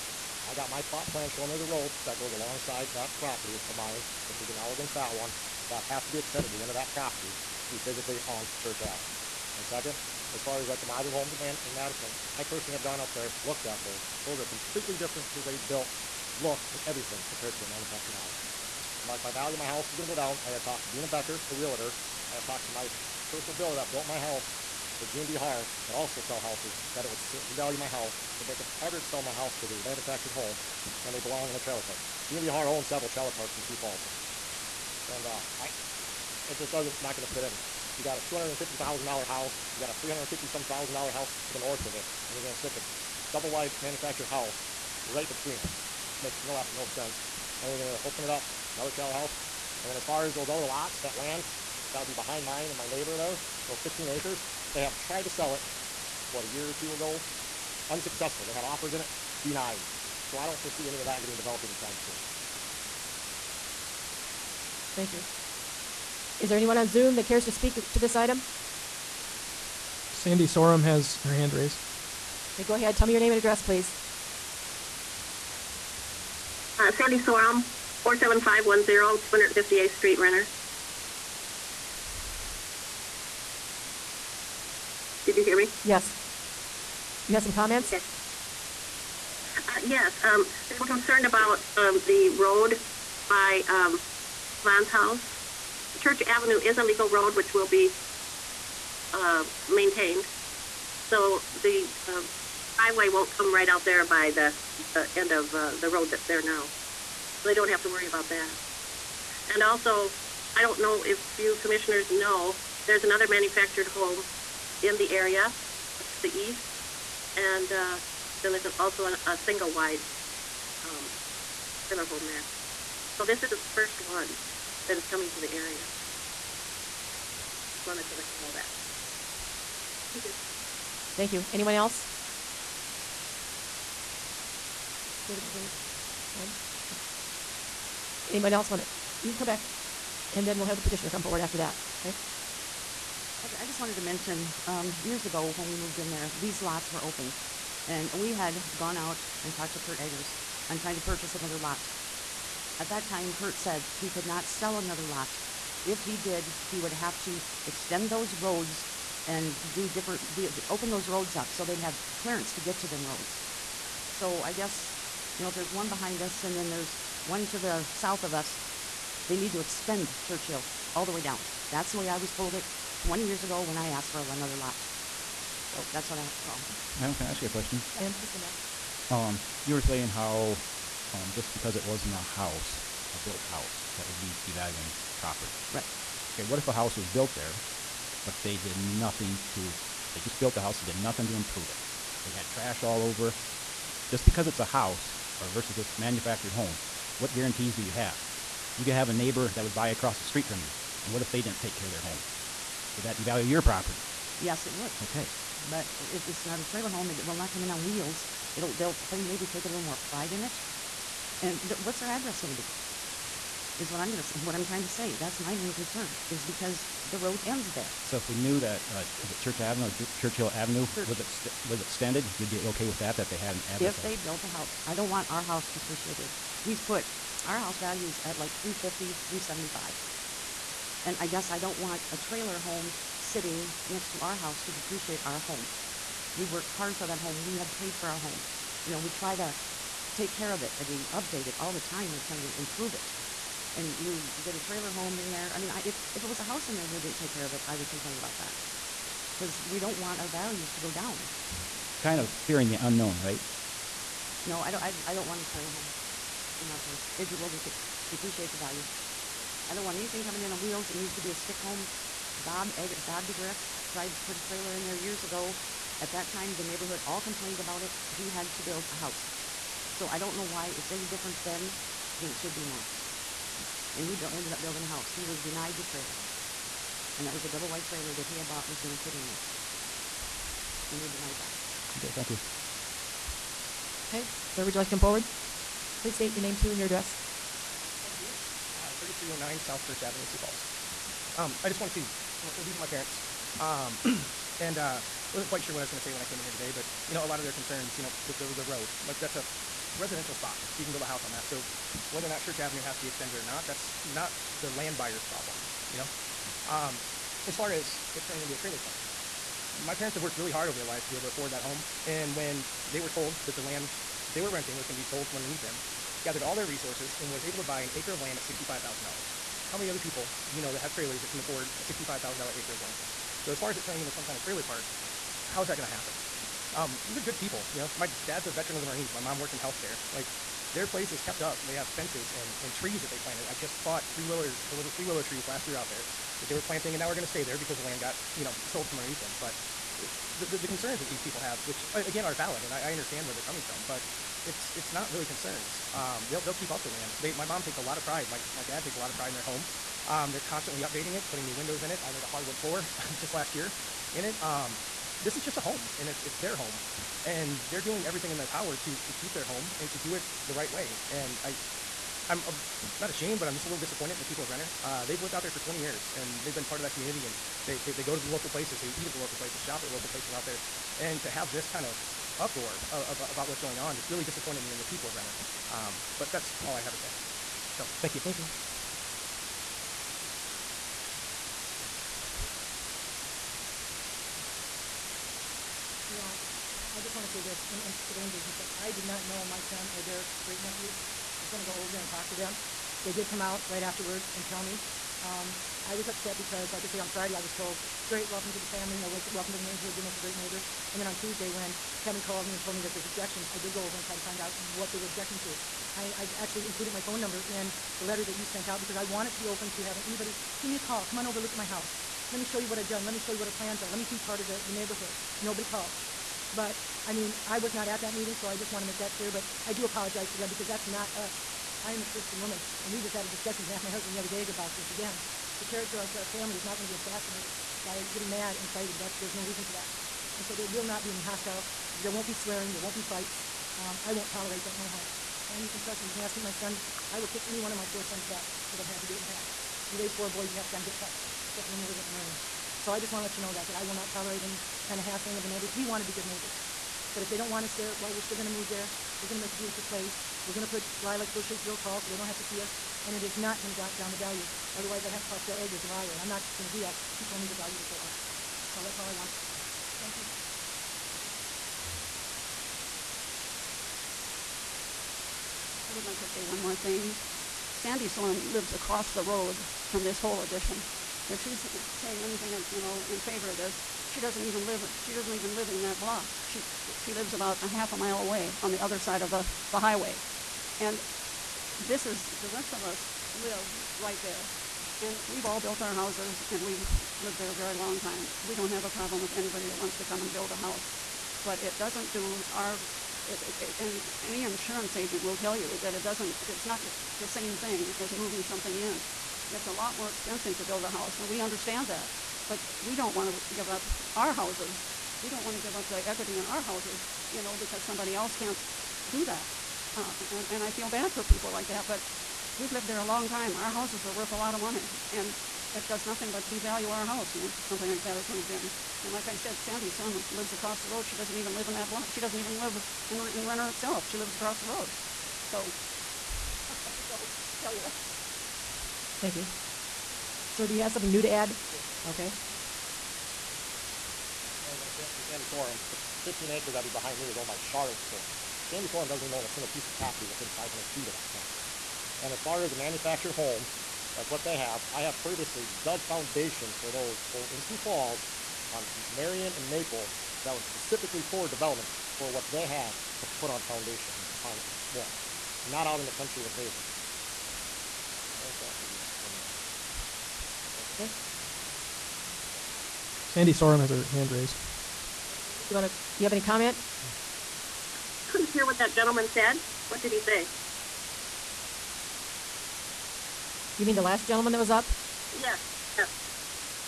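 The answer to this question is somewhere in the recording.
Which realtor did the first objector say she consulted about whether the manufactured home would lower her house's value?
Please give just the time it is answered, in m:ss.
0:20.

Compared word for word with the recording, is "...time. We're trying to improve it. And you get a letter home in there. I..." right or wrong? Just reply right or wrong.
wrong.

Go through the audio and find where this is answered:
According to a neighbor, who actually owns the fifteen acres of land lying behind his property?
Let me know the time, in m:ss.
8:57.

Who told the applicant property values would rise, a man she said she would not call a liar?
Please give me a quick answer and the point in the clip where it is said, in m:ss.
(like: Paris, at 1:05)
Phil Eggers, at 7:35.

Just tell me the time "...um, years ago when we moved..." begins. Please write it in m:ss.
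2:24.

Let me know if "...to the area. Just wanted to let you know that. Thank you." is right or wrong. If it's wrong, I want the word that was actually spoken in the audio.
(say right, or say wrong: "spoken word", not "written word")
right.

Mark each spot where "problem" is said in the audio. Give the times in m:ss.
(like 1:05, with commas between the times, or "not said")
5:05, 8:08.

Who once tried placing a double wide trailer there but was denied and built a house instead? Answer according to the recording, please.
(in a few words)
Bob DeGriff.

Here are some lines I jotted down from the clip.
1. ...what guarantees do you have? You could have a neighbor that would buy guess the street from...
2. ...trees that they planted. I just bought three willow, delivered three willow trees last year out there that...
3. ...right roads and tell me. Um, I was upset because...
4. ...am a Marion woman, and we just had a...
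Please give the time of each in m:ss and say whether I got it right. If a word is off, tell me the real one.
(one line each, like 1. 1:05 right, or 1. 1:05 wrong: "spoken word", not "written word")
1. 3:17 wrong: "across", not "guess"
2. 5:32 right
3. 6:33 wrong: "afterwards", not "roads"
4. 7:01 wrong: "Christian", not "Marion".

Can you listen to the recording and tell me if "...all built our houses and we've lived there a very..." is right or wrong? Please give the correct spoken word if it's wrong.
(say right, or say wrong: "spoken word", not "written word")
right.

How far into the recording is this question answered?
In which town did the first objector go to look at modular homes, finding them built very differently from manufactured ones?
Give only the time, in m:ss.
0:11.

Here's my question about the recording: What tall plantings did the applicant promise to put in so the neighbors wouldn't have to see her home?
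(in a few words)
Lilac bushes.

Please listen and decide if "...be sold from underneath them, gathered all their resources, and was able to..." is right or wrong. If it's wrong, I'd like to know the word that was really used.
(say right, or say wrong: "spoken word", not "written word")
right.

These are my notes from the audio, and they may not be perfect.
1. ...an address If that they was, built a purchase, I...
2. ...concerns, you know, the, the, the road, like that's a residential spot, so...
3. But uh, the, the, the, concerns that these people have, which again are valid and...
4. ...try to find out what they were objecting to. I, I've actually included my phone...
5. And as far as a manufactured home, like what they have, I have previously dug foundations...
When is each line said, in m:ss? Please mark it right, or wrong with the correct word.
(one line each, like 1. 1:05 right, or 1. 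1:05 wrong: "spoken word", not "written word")
1. 3:43 wrong: "house", not "purchase"
2. 4:57 right
3. 5:39 right
4. 6:44 right
5. 9:02 right.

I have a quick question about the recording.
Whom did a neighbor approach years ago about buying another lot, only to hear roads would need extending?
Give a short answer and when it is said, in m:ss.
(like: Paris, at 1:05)
Kurt Eggers, at 2:29.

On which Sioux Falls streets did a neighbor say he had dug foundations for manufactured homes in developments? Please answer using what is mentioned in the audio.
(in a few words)
Marion and Maple.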